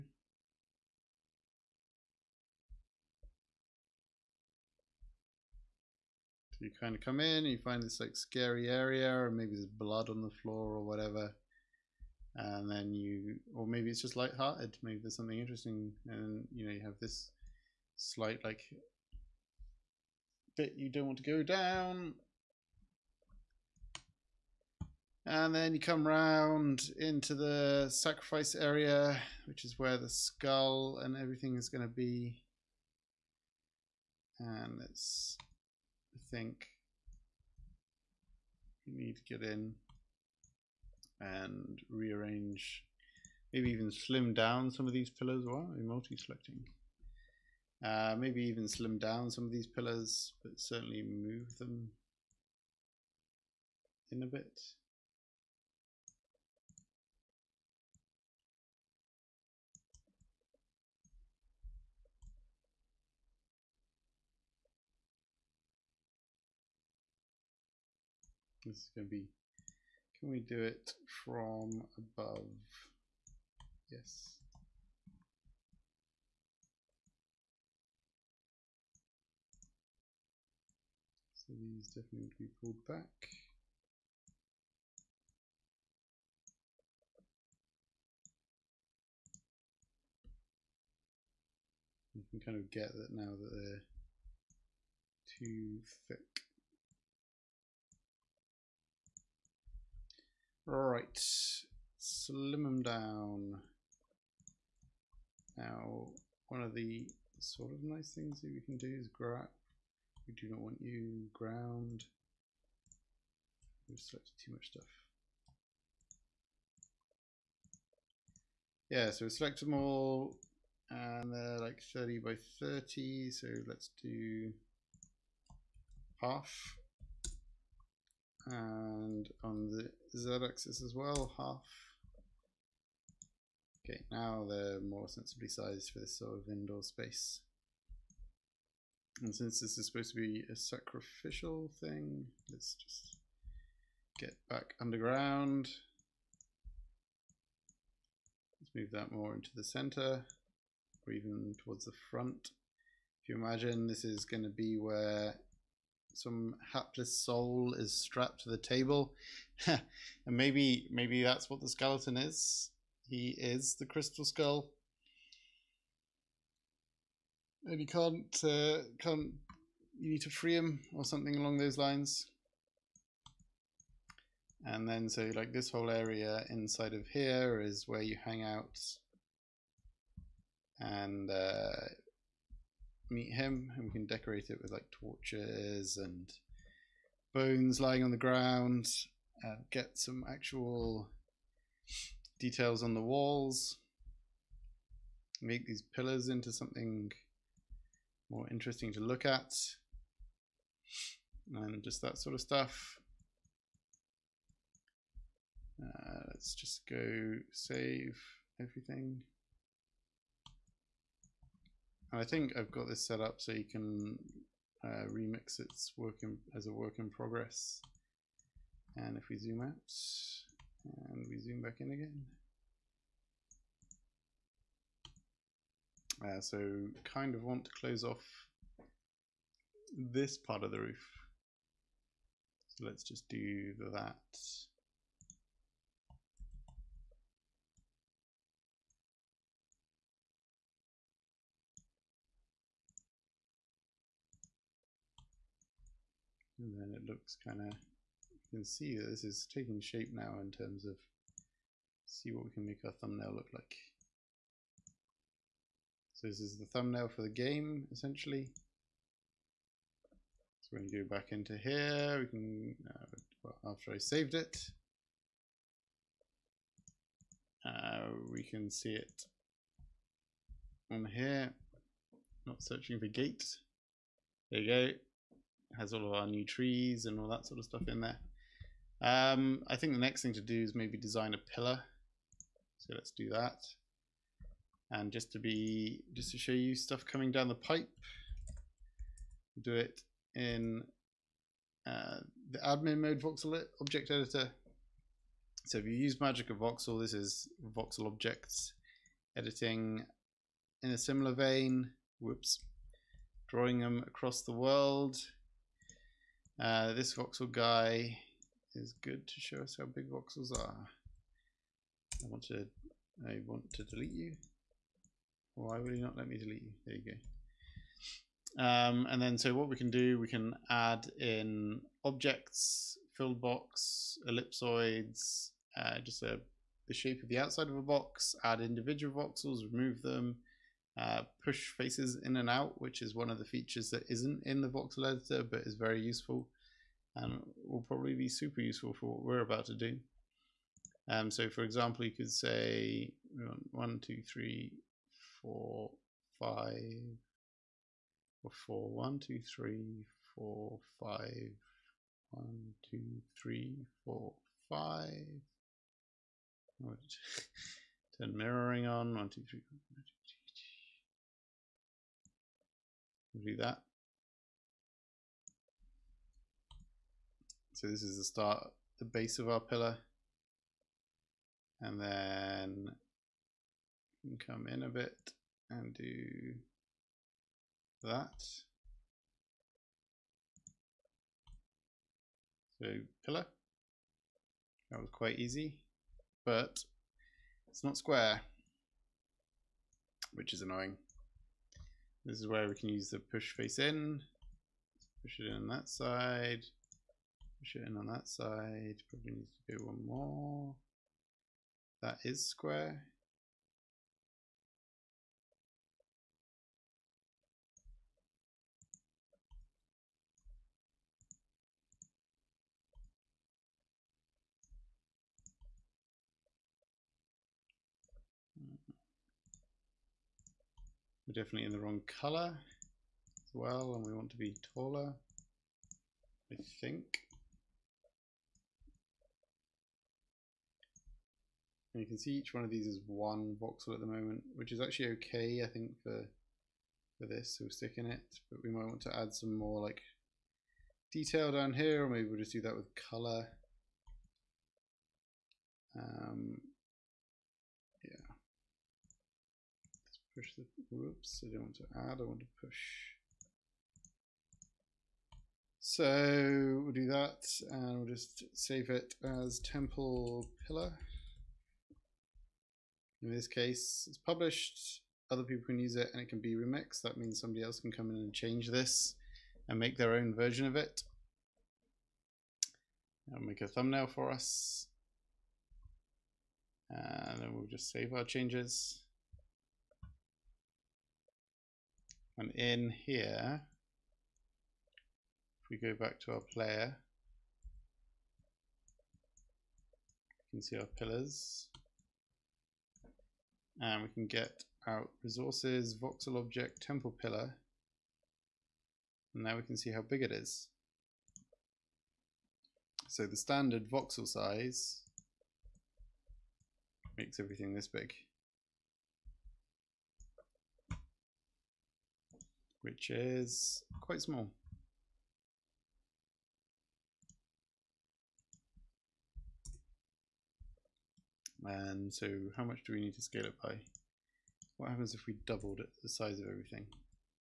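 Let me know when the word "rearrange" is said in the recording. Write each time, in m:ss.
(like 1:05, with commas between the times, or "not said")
0:41.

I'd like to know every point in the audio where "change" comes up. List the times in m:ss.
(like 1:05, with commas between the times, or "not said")
7:48, 7:58.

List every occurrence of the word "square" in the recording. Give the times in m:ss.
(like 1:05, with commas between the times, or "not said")
6:27, 6:42.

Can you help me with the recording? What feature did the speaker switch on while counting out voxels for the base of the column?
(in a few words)
mirroring.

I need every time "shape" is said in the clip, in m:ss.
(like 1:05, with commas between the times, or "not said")
4:09, 5:26.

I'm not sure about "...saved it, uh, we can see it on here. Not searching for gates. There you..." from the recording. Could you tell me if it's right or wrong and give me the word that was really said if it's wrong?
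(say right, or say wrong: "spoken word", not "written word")
right.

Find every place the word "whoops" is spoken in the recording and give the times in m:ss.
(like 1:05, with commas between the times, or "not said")
5:02, 7:30.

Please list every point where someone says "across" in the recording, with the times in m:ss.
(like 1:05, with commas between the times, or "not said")
5:04.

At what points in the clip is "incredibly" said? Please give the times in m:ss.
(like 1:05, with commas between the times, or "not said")
not said.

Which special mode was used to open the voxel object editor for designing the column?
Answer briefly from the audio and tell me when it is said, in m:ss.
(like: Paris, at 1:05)
admin mode, at 4:52.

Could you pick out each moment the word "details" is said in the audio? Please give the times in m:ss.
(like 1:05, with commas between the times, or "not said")
3:12, 7:21.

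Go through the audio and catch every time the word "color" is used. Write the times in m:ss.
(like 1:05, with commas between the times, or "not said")
7:02, 7:22.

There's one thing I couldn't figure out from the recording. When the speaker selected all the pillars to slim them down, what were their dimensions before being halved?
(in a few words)
30 by 30.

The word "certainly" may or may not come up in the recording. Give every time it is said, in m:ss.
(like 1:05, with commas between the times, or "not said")
0:50.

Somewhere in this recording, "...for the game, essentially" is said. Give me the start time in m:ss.
4:17.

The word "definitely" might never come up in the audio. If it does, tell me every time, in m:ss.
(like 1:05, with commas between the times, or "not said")
1:21, 7:01.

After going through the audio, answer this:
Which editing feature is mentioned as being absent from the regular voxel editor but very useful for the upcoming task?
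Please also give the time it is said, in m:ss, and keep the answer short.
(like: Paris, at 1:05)
push faces in and out, at 5:31.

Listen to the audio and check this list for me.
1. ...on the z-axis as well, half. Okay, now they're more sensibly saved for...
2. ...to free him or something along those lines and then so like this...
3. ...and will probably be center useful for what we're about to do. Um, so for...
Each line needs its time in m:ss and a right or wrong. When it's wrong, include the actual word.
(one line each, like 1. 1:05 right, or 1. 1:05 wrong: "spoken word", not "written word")
1. 2:09 wrong: "sized", not "saved"
2. 2:50 right
3. 5:37 wrong: "super", not "center".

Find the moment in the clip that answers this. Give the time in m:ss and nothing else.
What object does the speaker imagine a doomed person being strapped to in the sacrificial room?
2:38.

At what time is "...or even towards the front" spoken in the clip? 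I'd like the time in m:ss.
2:31.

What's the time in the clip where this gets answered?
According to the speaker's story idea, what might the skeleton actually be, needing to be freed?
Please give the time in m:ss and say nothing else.
2:43.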